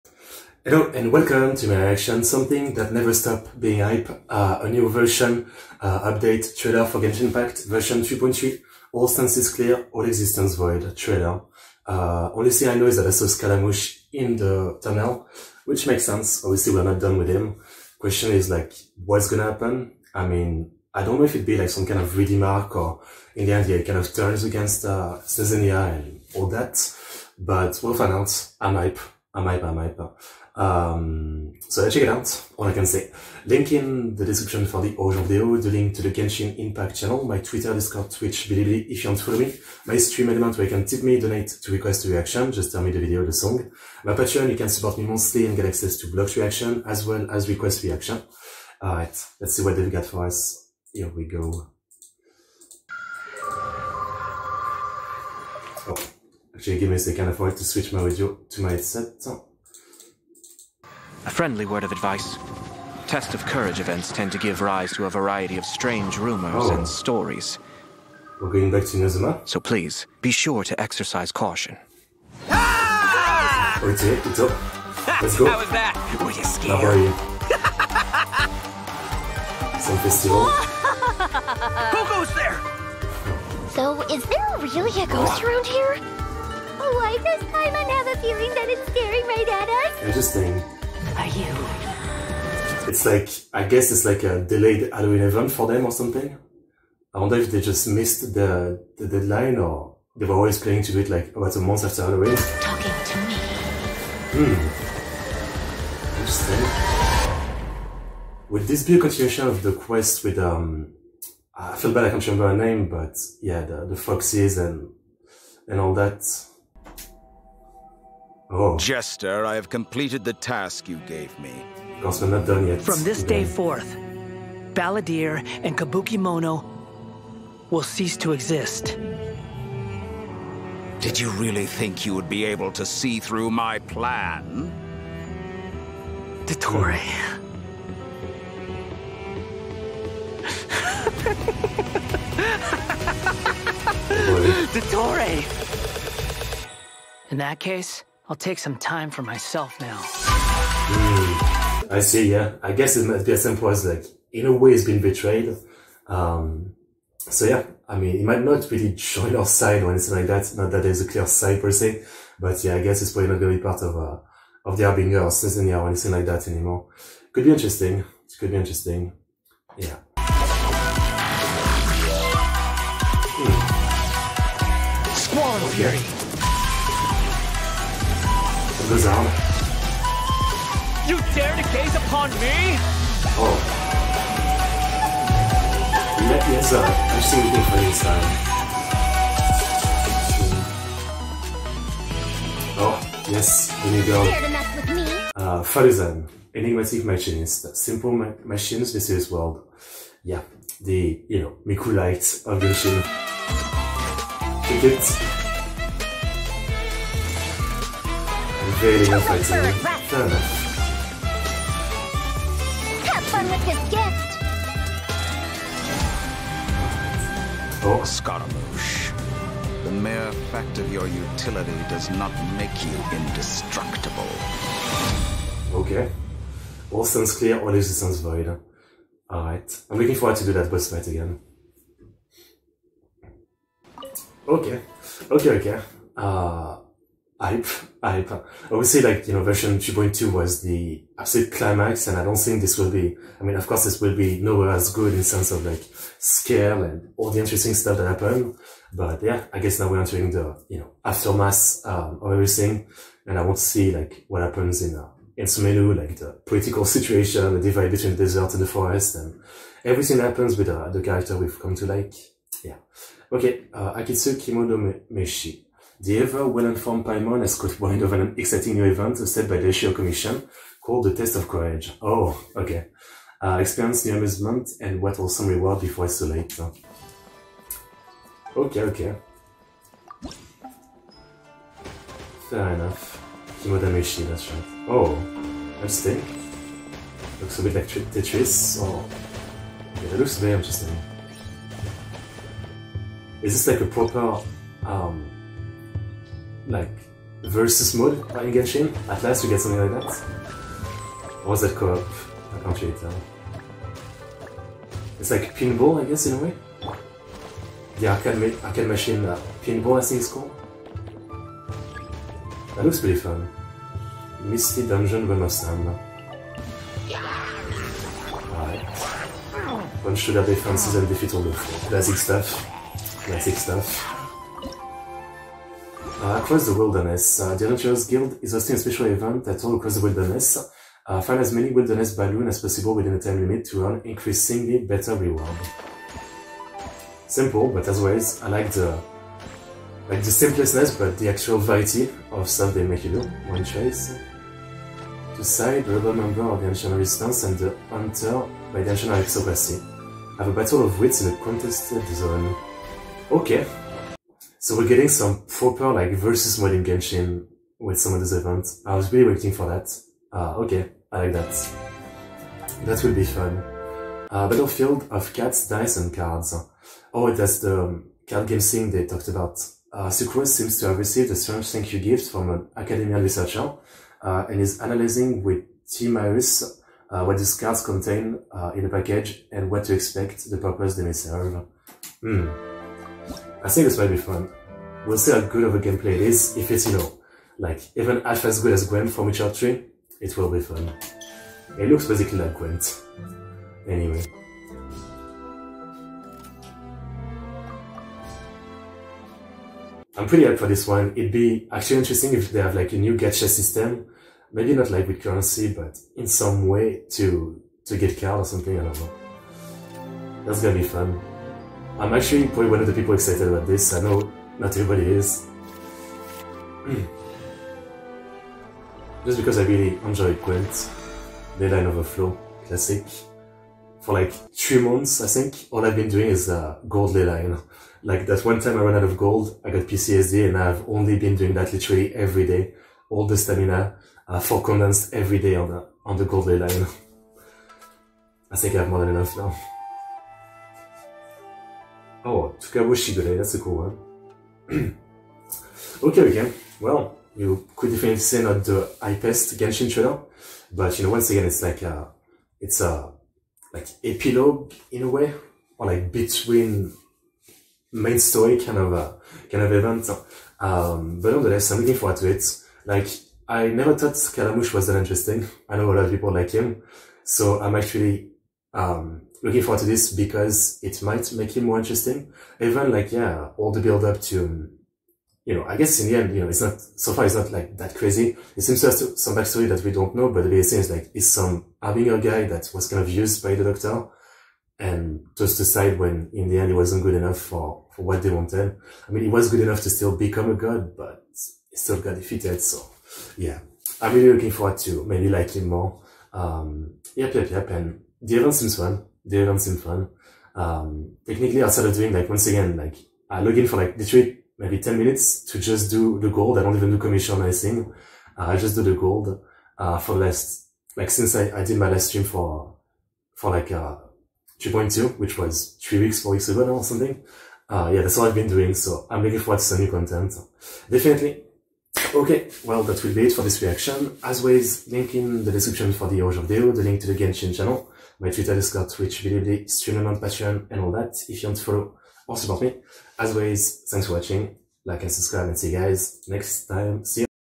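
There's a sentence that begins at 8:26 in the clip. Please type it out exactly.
I don't even do commission or anything.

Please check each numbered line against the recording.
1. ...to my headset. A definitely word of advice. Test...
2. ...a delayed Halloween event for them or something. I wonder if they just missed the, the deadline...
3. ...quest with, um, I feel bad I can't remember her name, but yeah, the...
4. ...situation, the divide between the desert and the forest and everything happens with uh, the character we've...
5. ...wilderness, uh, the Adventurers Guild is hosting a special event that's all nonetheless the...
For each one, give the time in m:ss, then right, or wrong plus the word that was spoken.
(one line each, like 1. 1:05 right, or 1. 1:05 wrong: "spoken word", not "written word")
1. 0:58 wrong: "friendly", not "definitely"
2. 1:34 right
3. 1:49 right
4. 4:16 right
5. 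5:26 wrong: "across", not "nonetheless".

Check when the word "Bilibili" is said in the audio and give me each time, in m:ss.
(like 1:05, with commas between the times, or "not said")
0:38, 8:49.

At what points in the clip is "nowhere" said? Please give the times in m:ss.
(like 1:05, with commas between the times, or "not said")
4:04.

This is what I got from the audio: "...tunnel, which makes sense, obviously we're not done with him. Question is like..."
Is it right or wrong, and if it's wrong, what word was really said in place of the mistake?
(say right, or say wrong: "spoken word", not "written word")
right.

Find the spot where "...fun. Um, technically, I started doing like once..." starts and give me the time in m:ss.
8:19.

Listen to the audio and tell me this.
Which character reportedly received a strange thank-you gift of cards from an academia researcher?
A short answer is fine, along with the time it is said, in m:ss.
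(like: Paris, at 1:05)
Sucrose, at 6:10.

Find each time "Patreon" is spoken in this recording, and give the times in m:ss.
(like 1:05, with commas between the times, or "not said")
0:44, 8:50.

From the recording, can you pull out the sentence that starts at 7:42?
Like, I never thought Scaramouche was that interesting.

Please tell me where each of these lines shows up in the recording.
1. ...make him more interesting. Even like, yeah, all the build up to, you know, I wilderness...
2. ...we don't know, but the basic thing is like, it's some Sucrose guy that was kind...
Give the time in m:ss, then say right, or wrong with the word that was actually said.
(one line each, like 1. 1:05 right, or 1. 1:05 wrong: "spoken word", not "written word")
1. 7:51 wrong: "guess", not "wilderness"
2. 7:59 wrong: "Harbinger", not "Sucrose".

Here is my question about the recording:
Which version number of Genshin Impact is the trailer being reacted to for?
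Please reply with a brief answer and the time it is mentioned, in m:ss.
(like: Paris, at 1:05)
3.3, at 0:07.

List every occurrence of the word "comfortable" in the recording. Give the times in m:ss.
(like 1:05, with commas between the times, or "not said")
not said.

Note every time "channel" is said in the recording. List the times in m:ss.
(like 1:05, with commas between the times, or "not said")
0:36, 8:47.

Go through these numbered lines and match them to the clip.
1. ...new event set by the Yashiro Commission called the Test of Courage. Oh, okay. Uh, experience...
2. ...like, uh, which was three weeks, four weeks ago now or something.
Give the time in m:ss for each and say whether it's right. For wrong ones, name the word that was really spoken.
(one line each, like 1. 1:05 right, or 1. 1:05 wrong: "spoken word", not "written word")
1. 4:28 right
2. 8:33 right.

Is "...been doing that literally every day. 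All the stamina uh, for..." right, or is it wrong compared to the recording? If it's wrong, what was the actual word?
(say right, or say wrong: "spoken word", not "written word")
right.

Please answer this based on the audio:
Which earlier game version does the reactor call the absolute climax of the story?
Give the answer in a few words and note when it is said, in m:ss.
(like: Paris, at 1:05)
2.2, at 3:59.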